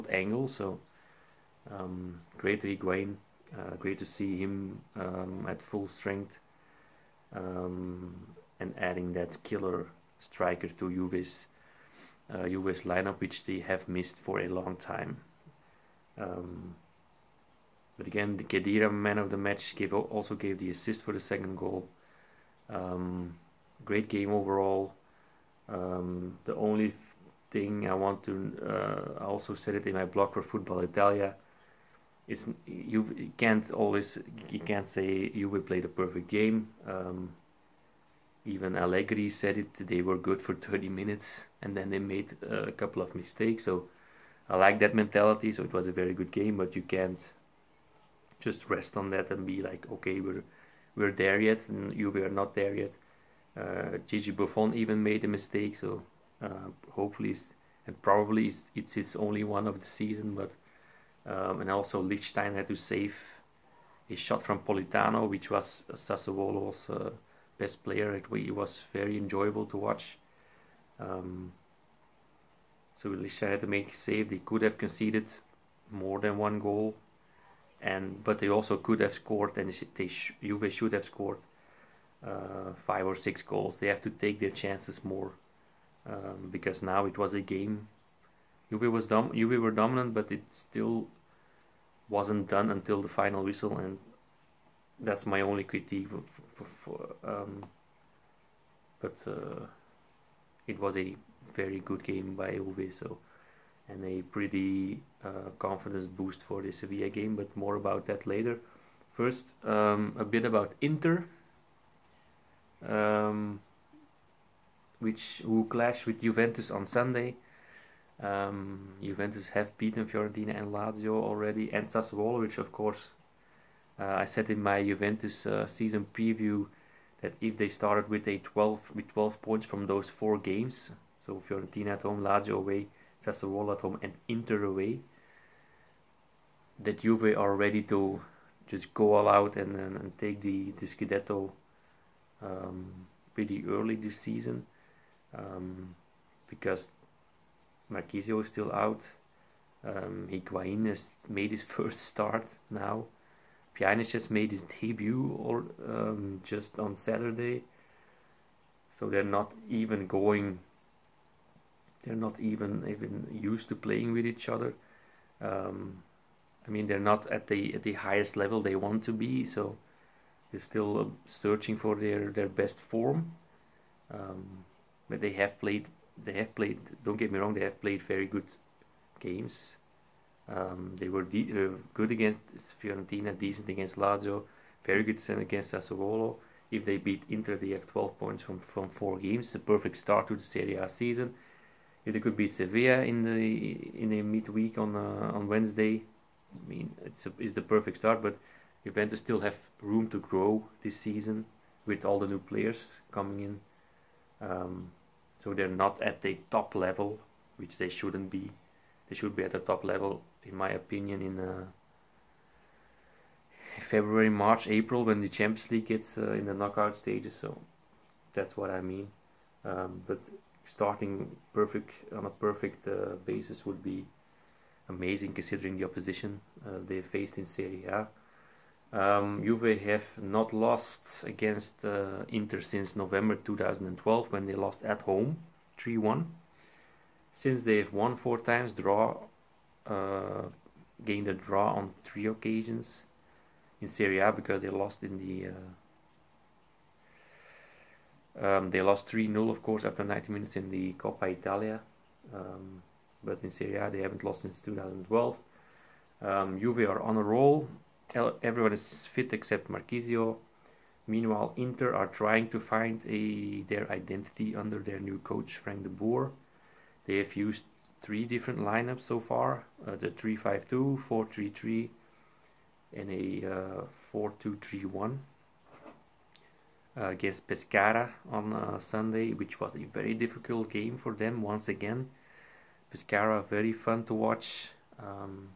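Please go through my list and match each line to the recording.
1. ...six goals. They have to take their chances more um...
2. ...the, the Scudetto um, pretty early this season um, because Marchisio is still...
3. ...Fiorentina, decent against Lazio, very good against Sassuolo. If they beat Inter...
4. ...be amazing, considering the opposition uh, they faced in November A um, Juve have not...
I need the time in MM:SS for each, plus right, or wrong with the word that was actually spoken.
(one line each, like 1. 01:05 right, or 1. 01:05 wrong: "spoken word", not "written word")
1. 01:23 right
2. 02:20 right
3. 03:02 right
4. 03:43 wrong: "Serie", not "November".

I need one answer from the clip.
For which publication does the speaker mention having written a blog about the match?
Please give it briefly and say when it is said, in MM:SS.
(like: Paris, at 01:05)
Football Italia, at 00:30.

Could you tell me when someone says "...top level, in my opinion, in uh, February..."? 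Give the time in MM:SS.
03:29.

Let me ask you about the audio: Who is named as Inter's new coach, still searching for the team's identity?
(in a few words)
Frank de Boer.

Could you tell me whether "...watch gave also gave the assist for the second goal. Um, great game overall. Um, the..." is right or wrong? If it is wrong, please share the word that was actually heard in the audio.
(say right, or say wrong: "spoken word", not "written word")
wrong: "match", not "watch".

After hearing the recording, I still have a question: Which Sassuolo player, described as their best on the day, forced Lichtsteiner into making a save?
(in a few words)
Politano.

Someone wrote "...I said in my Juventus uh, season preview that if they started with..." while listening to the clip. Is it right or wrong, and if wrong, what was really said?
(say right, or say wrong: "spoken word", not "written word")
right.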